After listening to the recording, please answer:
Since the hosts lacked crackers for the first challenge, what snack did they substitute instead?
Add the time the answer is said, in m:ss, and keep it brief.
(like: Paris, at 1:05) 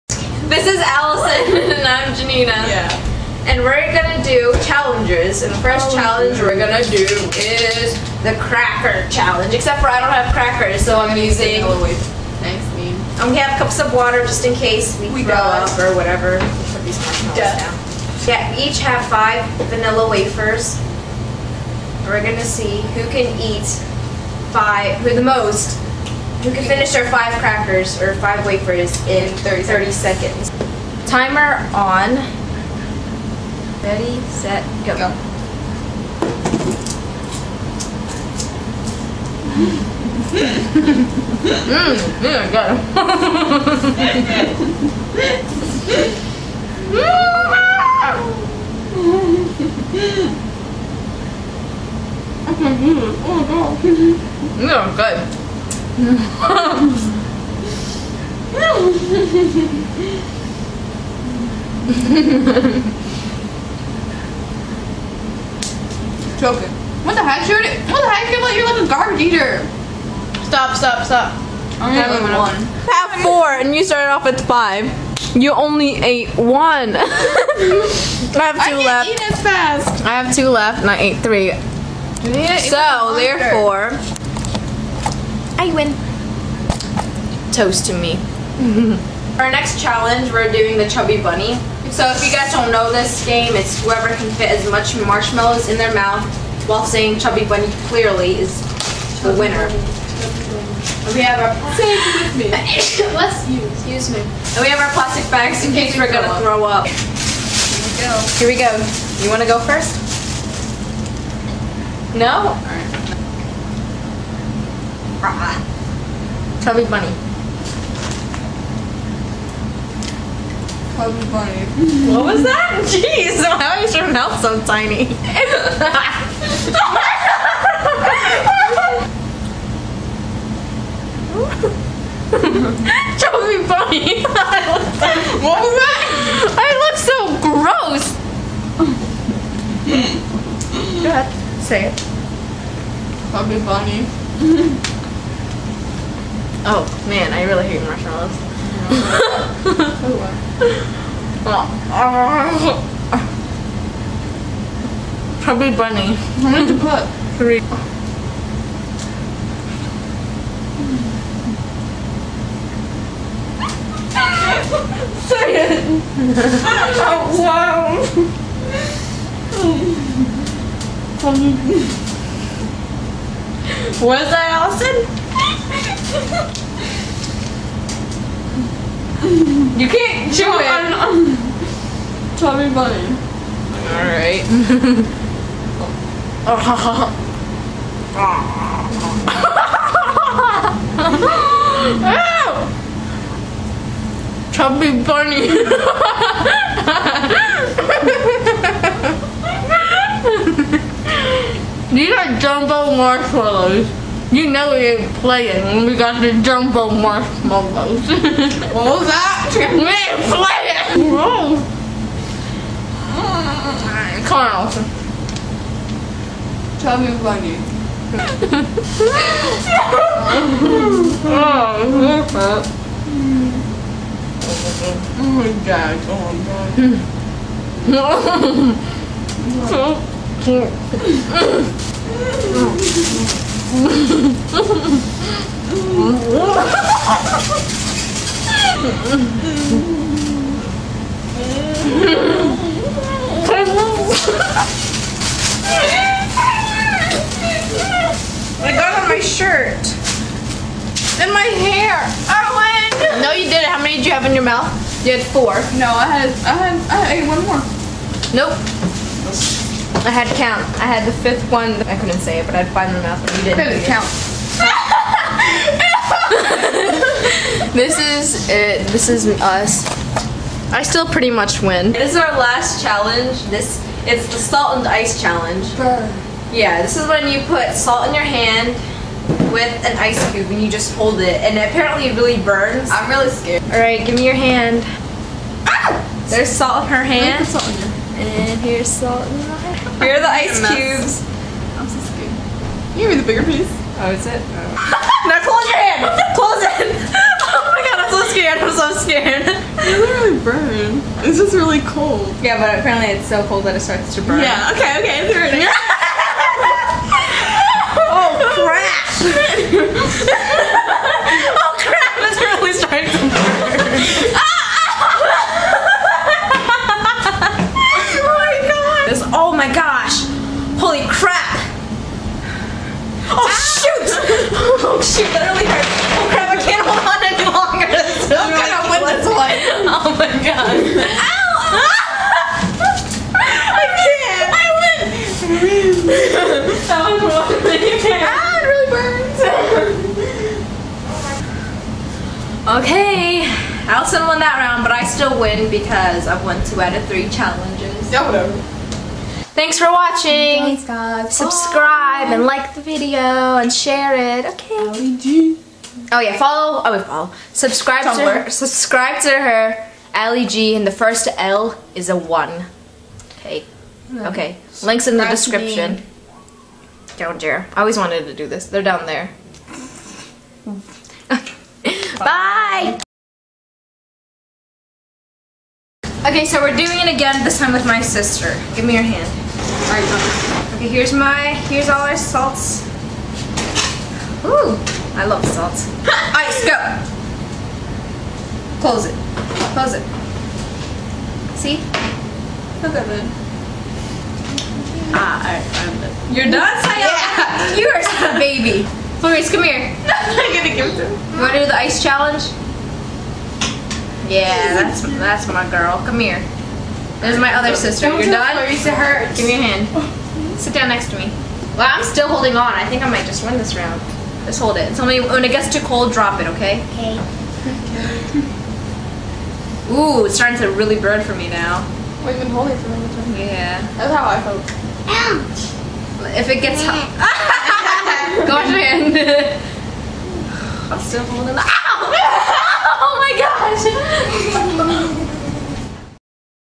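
vanilla wafers, at 0:19.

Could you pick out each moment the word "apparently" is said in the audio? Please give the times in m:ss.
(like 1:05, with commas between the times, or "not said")
4:41, 5:02.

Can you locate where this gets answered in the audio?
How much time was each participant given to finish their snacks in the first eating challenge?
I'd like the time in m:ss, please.
0:29.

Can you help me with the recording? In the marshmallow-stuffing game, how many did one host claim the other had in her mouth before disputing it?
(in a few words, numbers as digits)
4.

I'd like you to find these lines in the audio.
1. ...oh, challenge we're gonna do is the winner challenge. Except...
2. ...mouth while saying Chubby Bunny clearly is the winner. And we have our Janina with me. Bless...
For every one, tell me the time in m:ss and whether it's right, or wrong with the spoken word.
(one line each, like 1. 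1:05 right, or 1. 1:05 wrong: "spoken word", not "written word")
1. 0:05 wrong: "cracker", not "winner"
2. 1:35 wrong: "Say", not "Janina".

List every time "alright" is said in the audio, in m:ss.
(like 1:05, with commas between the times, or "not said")
4:43, 6:19, 6:35.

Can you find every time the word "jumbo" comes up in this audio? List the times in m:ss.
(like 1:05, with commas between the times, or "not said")
3:22, 3:26.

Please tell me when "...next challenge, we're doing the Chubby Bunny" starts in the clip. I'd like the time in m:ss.
1:29.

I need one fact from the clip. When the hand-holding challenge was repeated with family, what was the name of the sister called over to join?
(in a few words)
Florence.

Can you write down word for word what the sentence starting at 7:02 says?
Well, you've been holding for a long time.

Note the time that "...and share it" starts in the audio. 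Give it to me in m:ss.
5:53.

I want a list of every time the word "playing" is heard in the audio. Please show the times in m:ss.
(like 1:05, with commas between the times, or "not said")
3:25, 3:30.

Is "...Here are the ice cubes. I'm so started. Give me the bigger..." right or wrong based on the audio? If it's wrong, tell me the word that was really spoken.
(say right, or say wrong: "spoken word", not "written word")
wrong: "scared", not "started".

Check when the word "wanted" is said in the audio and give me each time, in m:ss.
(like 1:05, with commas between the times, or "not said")
6:07.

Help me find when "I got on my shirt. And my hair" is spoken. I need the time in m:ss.
4:08.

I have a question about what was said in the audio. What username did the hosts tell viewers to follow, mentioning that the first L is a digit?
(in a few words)
Ally G.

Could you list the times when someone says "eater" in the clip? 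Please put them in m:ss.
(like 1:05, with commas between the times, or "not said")
1:09.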